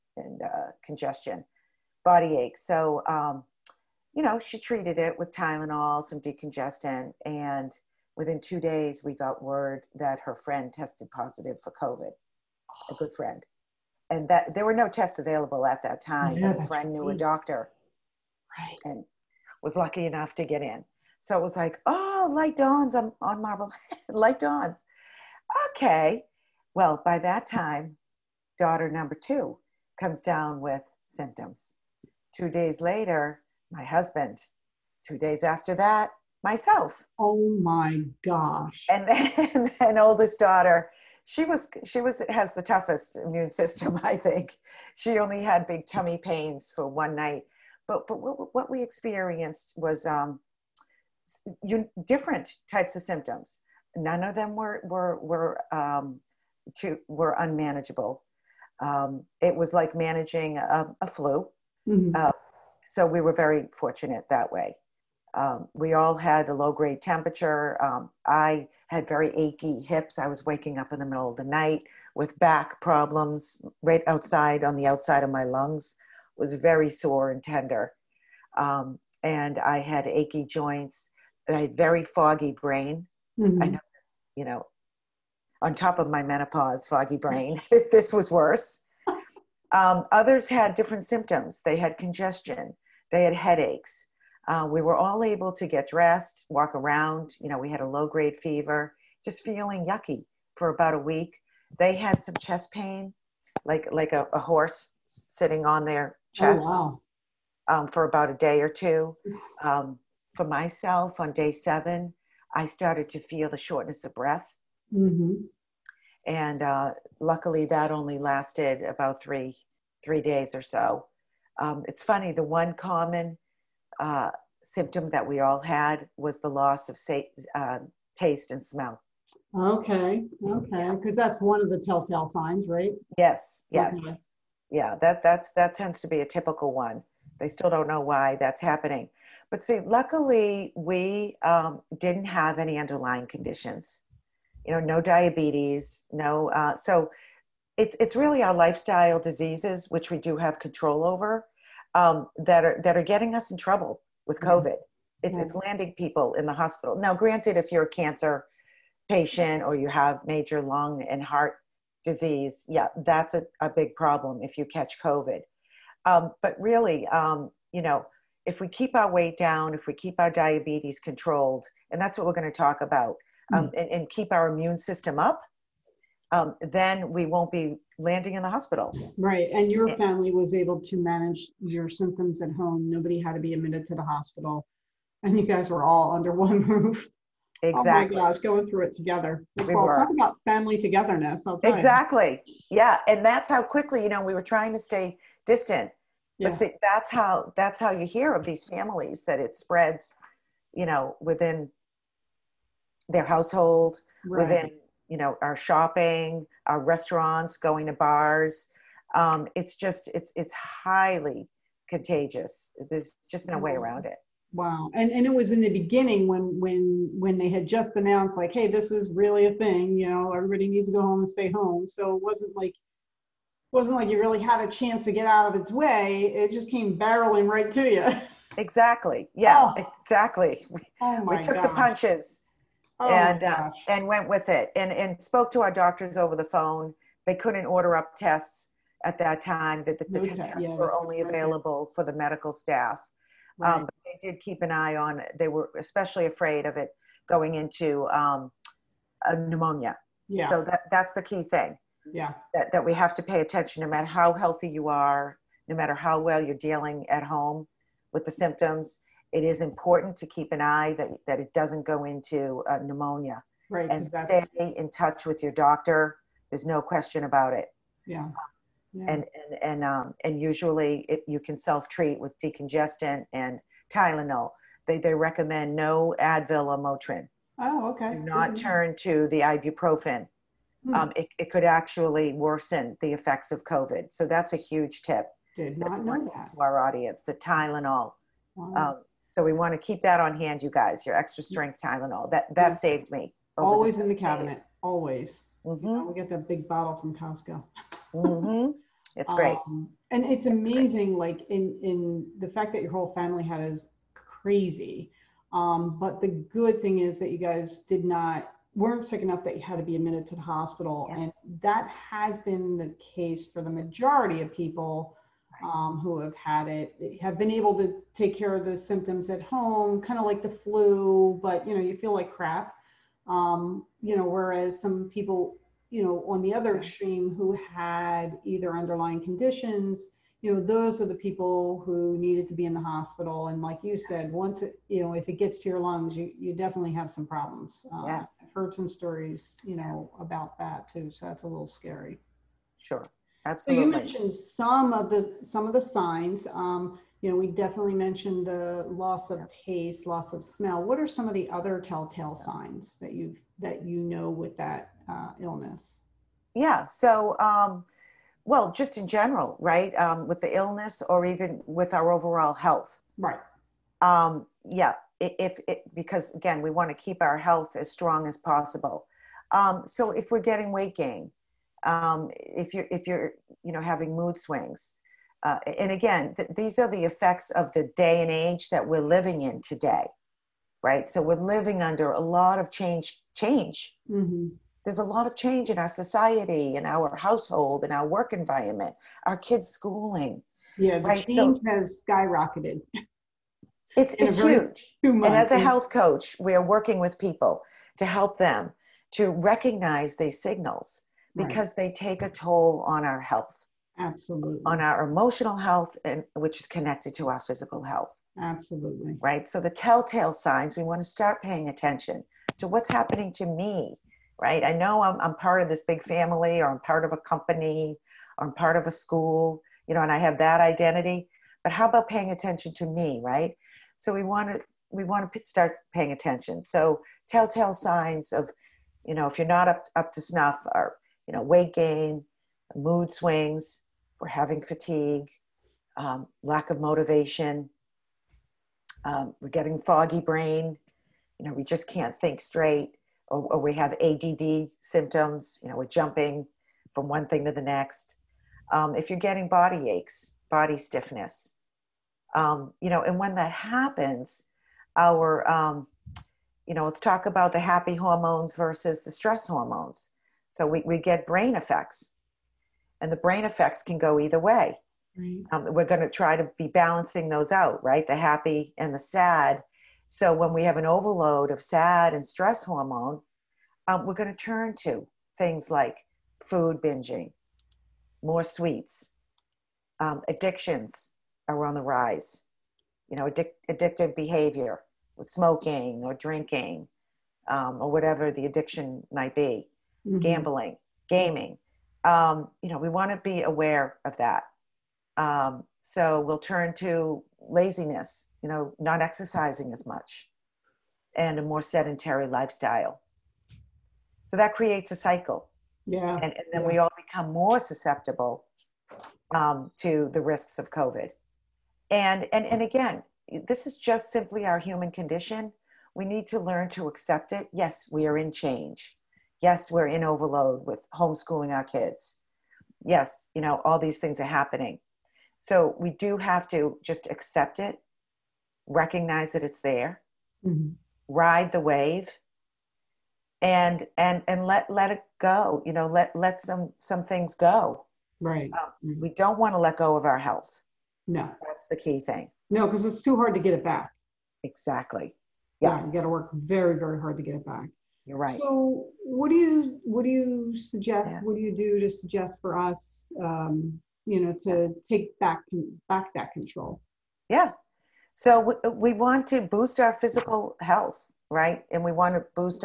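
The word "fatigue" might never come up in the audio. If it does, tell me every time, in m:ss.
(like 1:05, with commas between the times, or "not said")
7:14.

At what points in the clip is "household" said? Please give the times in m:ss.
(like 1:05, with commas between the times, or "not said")
3:23, 6:27.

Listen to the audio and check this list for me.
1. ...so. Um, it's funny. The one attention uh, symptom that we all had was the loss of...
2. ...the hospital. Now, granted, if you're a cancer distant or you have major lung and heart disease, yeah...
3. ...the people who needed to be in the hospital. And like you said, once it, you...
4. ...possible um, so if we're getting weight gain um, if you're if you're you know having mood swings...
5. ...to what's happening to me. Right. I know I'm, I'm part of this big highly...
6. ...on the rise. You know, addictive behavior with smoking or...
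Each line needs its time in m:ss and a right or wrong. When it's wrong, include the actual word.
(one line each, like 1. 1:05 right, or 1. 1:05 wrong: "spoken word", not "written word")
1. 2:00 wrong: "common", not "attention"
2. 2:36 wrong: "patient", not "distant"
3. 5:31 right
4. 6:08 right
5. 6:52 wrong: "family", not "highly"
6. 8:01 right.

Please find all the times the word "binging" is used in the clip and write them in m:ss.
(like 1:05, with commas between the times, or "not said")
7:56.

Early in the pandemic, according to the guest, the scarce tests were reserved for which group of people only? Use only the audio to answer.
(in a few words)
medical staff.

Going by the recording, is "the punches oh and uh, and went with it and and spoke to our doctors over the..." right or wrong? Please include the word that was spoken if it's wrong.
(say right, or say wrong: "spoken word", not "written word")
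right.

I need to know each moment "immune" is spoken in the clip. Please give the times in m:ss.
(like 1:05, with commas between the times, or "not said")
0:43, 2:54.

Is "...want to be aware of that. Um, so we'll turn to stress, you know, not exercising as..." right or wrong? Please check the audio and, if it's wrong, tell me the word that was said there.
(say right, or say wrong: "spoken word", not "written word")
wrong: "laziness", not "stress".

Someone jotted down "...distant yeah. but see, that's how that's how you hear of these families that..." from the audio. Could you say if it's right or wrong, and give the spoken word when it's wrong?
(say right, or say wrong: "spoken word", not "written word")
right.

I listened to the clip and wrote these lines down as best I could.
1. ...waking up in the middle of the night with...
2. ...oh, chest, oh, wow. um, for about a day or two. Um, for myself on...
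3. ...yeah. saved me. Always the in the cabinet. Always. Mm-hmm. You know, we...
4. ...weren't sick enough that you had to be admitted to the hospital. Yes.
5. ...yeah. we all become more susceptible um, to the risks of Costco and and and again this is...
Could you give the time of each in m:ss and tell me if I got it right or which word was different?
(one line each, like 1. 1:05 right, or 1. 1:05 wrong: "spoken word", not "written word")
1. 1:10 right
2. 1:46 right
3. 4:52 right
4. 5:08 right
5. 8:26 wrong: "COVID", not "Costco".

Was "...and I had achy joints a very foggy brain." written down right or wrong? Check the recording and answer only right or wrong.
right.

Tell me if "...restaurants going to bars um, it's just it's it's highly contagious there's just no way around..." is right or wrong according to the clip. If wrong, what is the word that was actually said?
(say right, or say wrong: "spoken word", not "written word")
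right.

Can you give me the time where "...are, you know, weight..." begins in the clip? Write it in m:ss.
7:10.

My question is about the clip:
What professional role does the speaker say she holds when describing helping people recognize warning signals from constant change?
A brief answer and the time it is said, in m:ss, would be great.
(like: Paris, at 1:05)
health coach, at 6:35.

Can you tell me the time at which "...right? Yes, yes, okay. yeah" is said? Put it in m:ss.
2:12.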